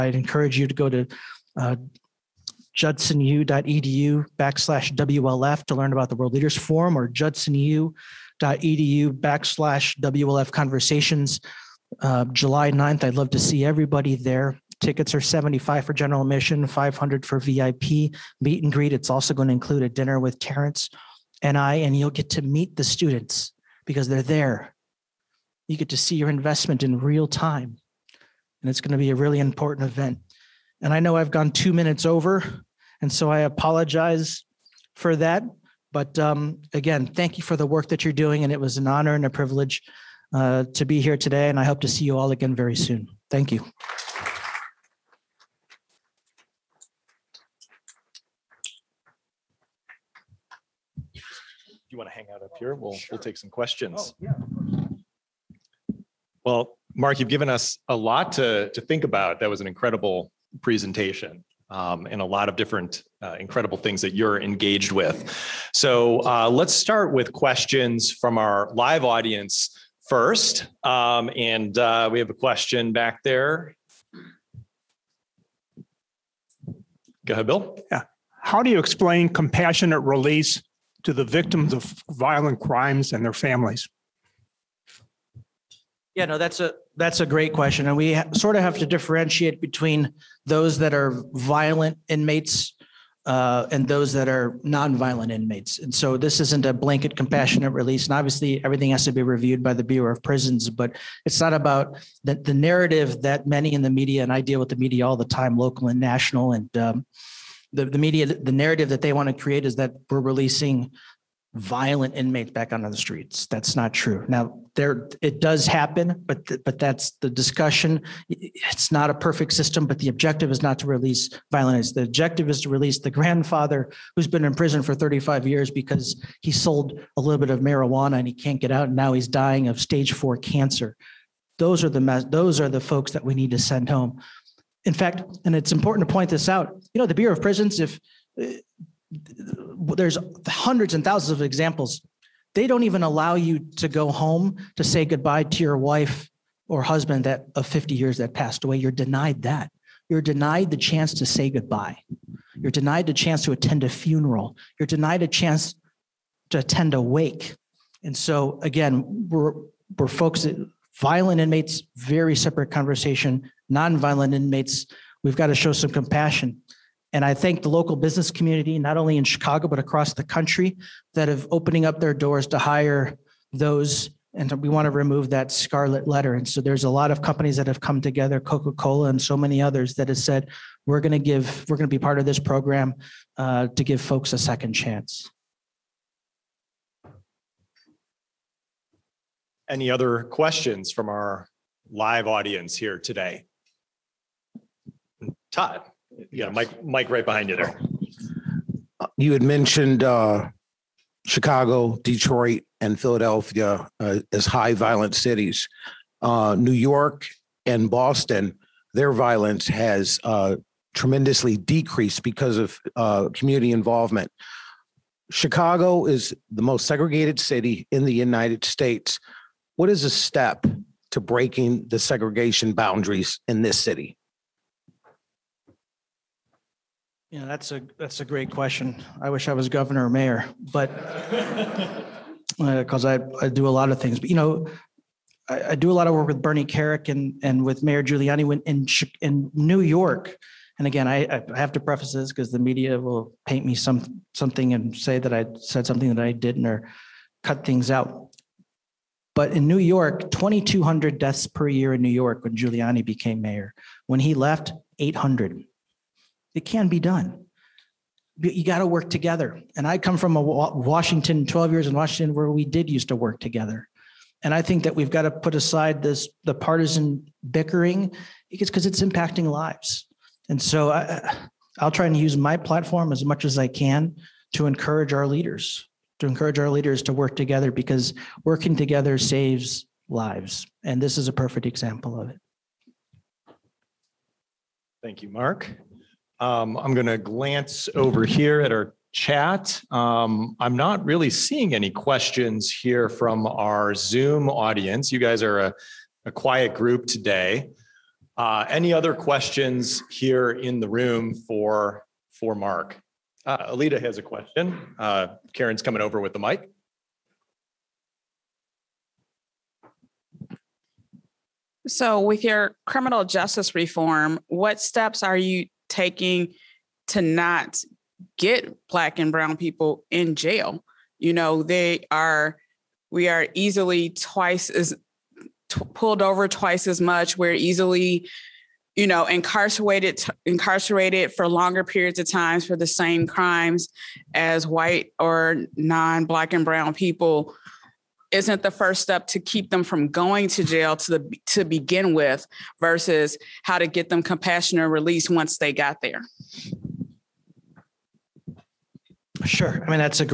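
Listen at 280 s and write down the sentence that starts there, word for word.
And this is a perfect example of it.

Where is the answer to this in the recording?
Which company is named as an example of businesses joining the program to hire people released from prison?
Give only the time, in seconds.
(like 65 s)
178 s.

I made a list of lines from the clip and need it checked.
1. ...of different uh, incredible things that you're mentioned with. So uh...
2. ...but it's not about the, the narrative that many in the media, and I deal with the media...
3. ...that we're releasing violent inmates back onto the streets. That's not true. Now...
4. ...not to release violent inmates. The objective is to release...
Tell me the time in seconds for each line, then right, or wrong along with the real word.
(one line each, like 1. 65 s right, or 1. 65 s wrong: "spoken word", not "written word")
1. 62 s wrong: "engaged", not "mentioned"
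2. 100 s right
3. 109 s right
4. 120 s right.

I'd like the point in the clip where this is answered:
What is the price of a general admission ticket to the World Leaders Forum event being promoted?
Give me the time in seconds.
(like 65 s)
15 s.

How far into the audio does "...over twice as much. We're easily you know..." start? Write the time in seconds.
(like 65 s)
326 s.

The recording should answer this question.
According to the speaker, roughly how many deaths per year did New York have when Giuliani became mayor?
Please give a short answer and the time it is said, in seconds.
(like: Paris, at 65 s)
2,200, at 250 s.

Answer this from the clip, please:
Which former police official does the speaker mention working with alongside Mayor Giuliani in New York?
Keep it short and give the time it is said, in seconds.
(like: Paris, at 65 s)
Bernie Kerik, at 236 s.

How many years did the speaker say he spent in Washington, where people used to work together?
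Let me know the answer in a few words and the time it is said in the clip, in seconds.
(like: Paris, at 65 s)
12, at 261 s.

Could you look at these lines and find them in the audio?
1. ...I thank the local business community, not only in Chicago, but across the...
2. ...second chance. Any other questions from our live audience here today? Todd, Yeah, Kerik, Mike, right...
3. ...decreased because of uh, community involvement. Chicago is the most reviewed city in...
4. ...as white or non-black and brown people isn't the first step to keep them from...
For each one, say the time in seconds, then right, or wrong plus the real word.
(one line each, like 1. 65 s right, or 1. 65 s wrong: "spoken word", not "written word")
1. 167 s right
2. 184 s wrong: "Mike", not "Kerik"
3. 211 s wrong: "segregated", not "reviewed"
4. 334 s right.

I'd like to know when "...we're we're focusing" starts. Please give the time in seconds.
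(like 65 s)
159 s.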